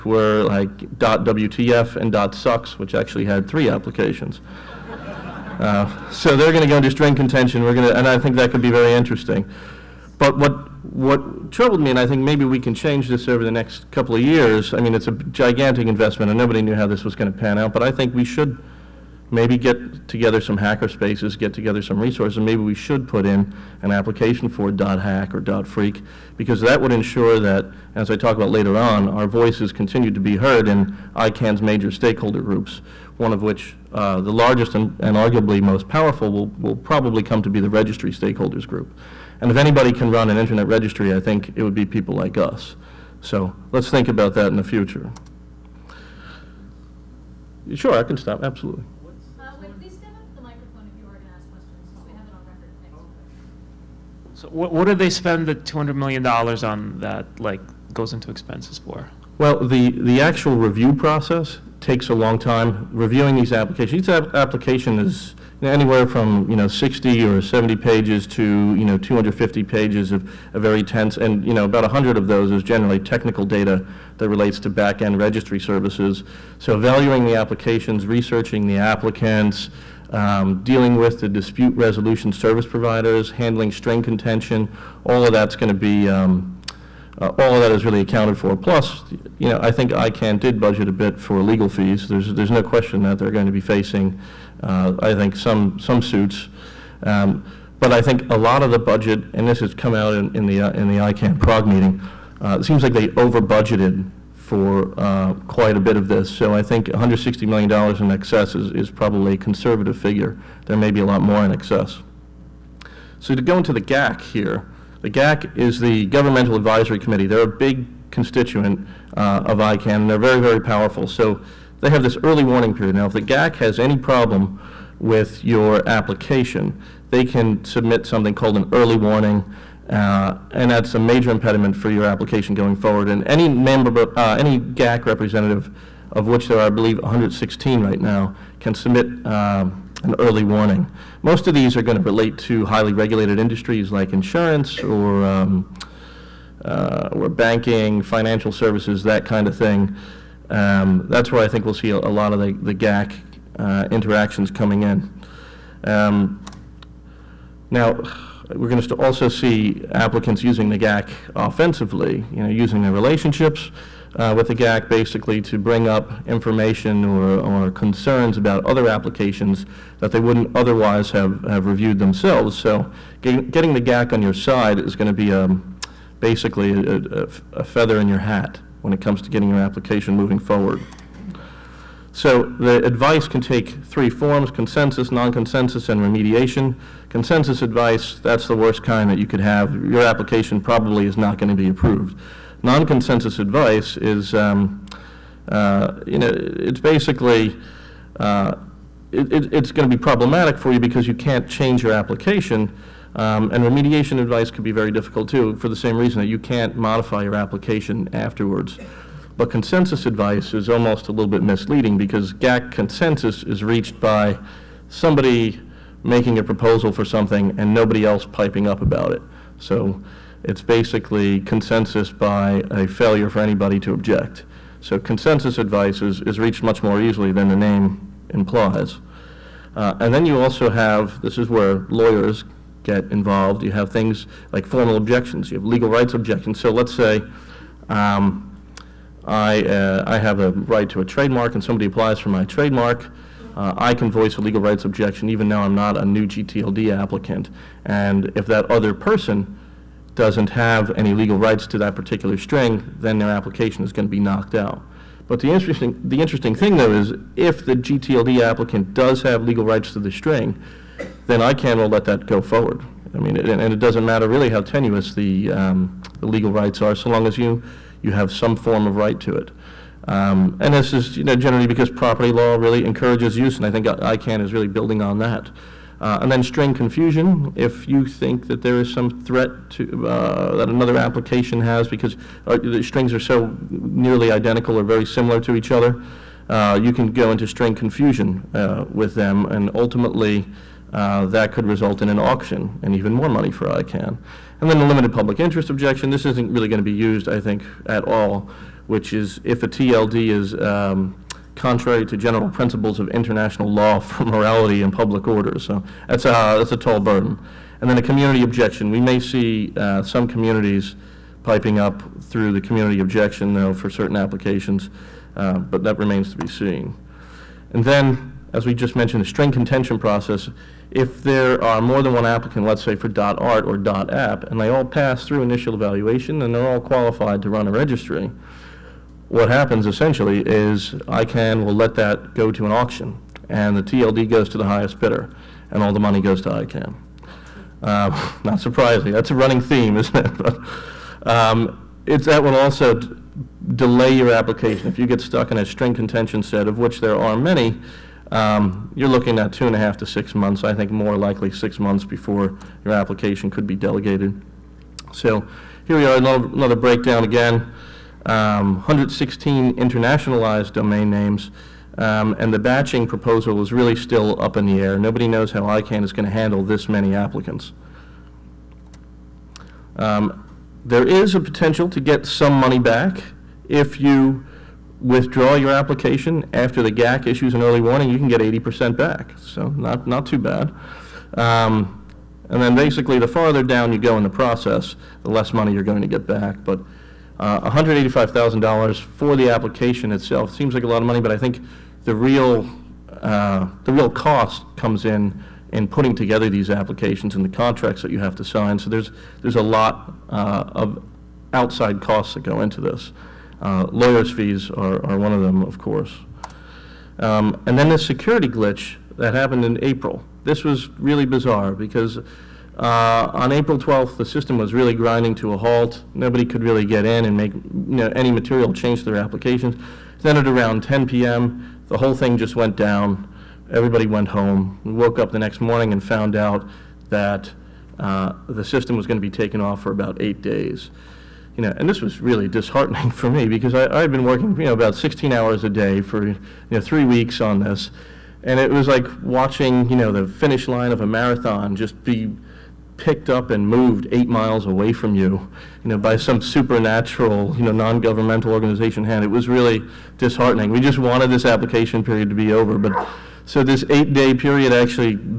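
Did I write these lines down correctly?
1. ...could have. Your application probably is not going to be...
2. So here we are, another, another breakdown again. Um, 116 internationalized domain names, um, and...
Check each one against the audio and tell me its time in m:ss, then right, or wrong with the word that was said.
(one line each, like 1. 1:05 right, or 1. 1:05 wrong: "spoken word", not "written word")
1. 3:09 right
2. 5:55 right.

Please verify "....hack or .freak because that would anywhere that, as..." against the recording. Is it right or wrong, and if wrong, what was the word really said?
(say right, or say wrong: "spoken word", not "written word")
wrong: "ensure", not "anywhere".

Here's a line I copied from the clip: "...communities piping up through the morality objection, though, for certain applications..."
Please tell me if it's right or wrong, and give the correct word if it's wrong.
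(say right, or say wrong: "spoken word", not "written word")
wrong: "community", not "morality".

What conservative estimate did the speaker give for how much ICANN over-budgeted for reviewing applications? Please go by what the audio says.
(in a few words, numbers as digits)
$160 million.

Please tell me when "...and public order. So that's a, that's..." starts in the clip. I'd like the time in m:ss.
5:04.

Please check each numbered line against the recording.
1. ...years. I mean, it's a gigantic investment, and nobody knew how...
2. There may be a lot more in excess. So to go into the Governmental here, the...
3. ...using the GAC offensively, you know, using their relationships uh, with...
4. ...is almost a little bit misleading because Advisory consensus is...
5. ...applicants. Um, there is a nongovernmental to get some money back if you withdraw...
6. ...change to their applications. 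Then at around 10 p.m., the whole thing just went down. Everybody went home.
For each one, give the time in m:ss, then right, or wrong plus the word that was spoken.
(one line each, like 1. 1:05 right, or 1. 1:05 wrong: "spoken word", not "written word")
1. 0:14 right
2. 1:50 wrong: "GAC", not "Governmental"
3. 2:40 right
4. 3:30 wrong: "GAC", not "Advisory"
5. 6:07 wrong: "potential", not "nongovernmental"
6. 6:58 right.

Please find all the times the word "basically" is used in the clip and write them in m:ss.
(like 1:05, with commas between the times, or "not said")
2:44, 2:56, 3:16, 3:40, 6:22.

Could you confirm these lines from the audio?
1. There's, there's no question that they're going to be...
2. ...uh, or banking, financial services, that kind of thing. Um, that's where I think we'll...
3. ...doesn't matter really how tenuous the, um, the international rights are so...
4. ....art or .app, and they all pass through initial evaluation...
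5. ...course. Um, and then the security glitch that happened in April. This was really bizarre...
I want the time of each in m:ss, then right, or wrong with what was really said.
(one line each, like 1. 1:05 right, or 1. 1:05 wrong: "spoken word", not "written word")
1. 1:32 right
2. 2:26 right
3. 4:23 wrong: "legal", not "international"
4. 5:23 right
5. 6:45 right.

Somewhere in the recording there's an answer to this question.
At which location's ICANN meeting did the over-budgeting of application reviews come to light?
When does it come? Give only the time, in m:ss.
1:41.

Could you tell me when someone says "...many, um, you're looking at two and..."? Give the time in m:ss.
5:47.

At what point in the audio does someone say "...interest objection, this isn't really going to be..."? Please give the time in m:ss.
4:55.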